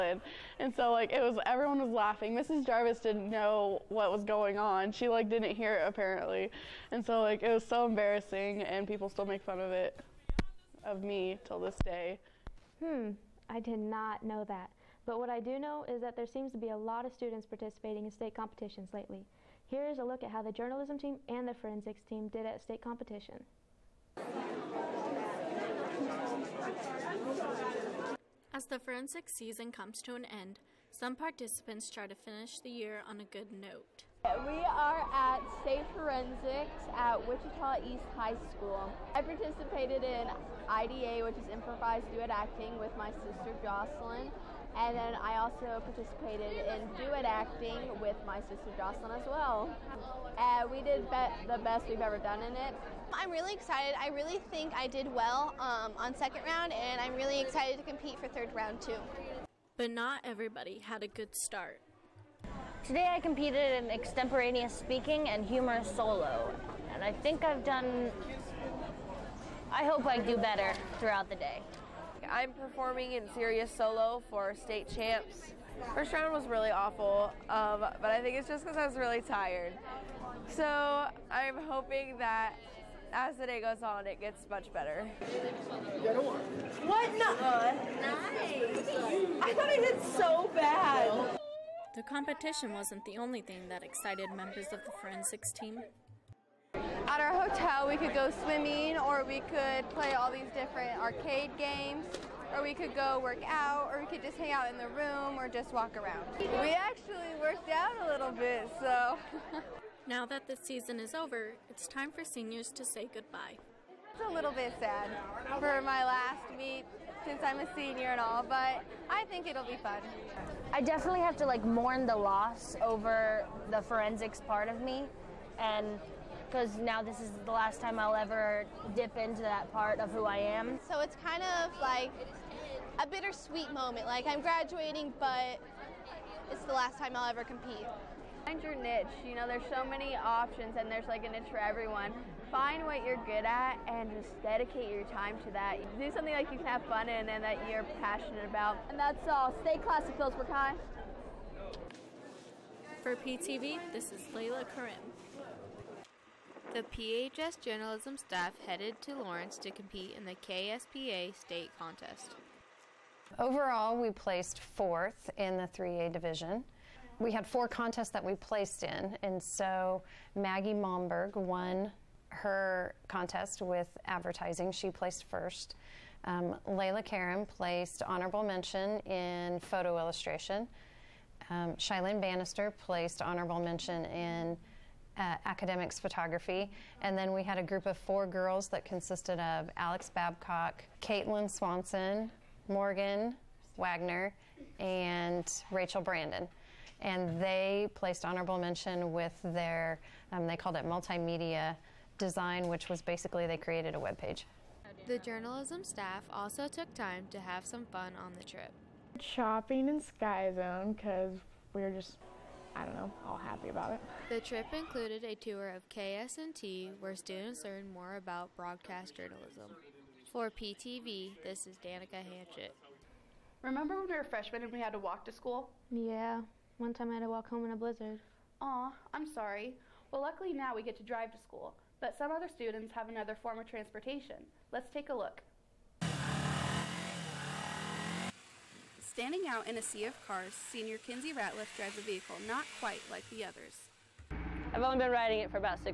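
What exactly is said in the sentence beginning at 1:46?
We actually worked out a little bit, so.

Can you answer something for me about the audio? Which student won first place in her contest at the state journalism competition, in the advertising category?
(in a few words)
Maggie Momberg.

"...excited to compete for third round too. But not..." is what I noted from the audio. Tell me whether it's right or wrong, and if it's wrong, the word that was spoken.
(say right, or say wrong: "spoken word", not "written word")
right.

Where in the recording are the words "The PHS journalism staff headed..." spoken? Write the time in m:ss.
2:36.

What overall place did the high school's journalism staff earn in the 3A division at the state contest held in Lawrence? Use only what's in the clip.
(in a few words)
fourth.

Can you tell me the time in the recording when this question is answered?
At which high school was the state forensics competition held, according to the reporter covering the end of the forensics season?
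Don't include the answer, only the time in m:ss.
0:37.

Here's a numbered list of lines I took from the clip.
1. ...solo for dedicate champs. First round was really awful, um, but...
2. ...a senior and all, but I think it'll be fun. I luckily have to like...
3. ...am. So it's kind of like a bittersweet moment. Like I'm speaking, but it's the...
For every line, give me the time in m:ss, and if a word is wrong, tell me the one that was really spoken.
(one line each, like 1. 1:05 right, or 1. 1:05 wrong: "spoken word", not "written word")
1. 1:13 wrong: "state", not "dedicate"
2. 1:57 wrong: "definitely", not "luckily"
3. 2:10 wrong: "graduating", not "speaking".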